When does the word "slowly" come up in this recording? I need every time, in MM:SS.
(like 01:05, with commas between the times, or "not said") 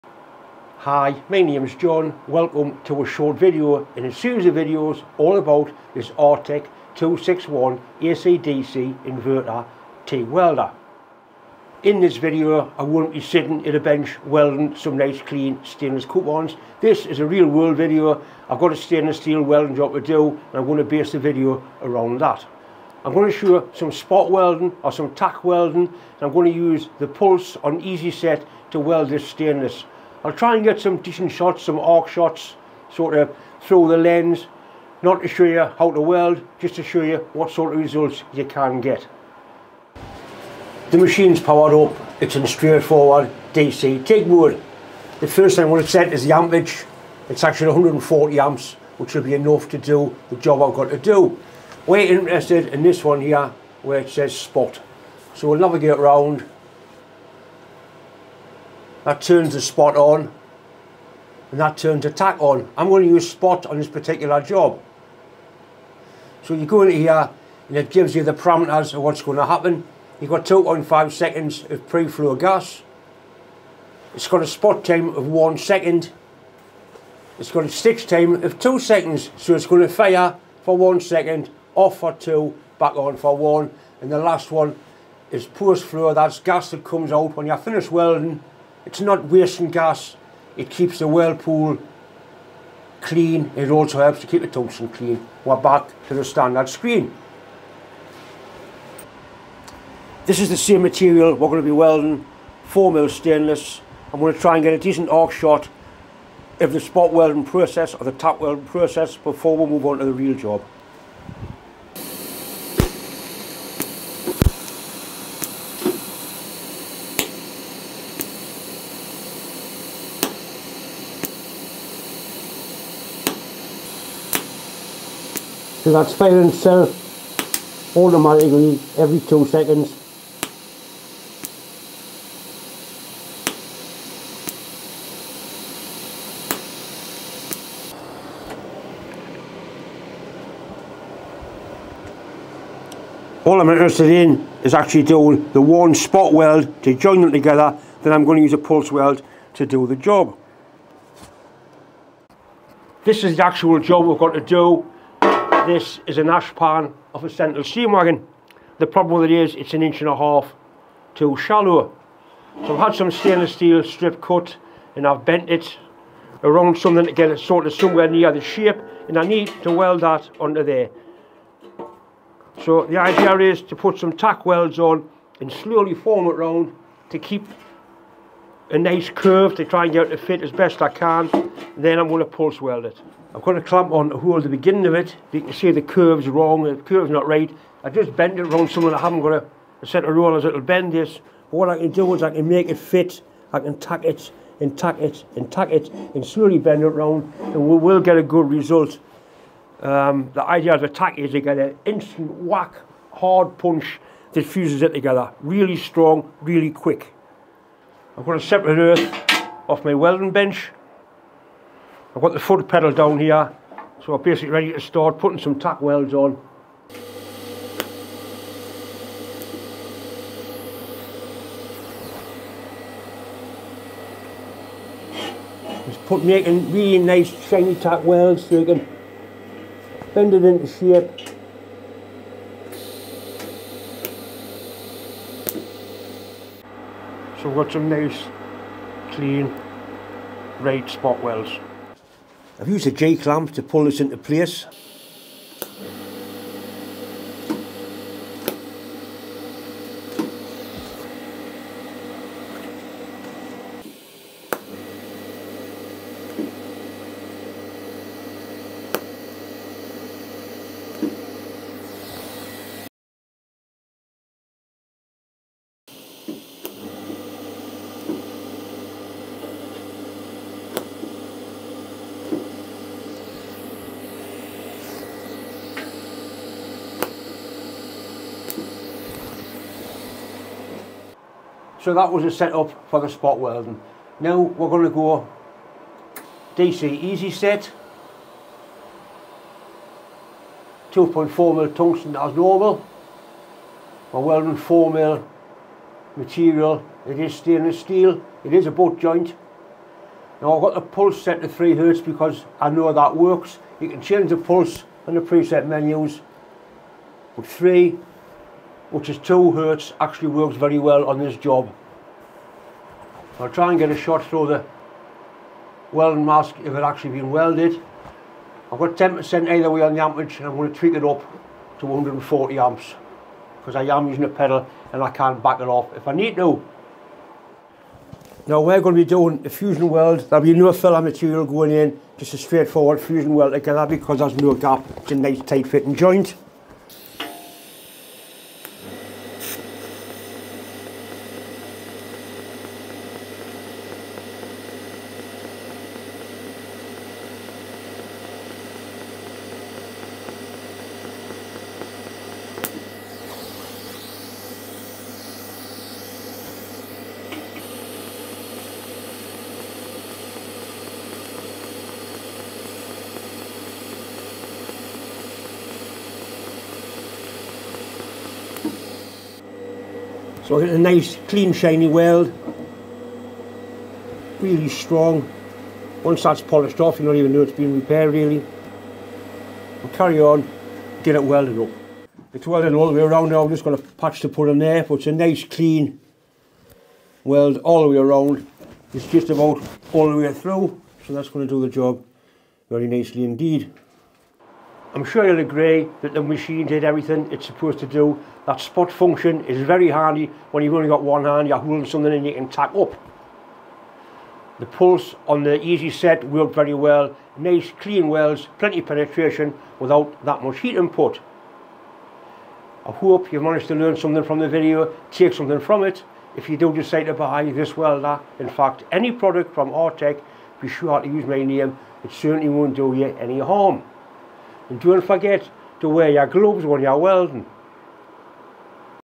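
02:55, 03:16.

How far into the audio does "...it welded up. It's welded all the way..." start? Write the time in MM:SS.
06:21.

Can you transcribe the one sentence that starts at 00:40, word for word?
The machine's powered up, it's in straightforward DC TIG wood.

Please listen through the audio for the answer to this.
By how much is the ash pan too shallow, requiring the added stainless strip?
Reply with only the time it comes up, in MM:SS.
02:39.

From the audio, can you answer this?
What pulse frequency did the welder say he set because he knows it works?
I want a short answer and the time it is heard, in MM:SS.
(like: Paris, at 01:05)
3 hertz, at 05:01.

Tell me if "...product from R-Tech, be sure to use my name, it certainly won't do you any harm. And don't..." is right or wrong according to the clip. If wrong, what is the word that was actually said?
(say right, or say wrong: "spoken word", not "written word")
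right.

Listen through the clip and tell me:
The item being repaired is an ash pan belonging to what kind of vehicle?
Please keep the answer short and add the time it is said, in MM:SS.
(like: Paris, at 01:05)
Sentinel steam wagon, at 02:37.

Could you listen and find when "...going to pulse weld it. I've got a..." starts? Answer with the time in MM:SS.
03:02.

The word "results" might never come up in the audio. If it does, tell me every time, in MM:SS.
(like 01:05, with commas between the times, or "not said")
00:37, 03:18.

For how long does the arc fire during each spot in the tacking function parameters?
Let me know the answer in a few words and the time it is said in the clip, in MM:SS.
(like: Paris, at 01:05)
1 second, at 01:14.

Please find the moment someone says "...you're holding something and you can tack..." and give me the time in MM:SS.
06:41.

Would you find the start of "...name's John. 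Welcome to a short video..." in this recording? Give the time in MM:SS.
00:01.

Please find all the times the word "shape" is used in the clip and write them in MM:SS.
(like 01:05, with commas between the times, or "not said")
02:48, 03:50.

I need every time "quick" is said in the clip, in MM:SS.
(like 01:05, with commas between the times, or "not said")
03:26.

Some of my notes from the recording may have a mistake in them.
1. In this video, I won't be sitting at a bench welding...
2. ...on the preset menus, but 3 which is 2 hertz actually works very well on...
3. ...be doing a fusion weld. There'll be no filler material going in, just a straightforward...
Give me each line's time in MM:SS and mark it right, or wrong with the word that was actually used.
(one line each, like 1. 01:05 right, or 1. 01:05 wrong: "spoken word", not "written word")
1. 00:11 right
2. 05:05 right
3. 05:29 right.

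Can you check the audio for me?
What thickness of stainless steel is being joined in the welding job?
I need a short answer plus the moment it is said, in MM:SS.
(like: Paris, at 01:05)
4 mil, at 01:42.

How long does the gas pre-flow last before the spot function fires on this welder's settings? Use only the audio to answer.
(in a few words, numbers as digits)
2.5 seconds.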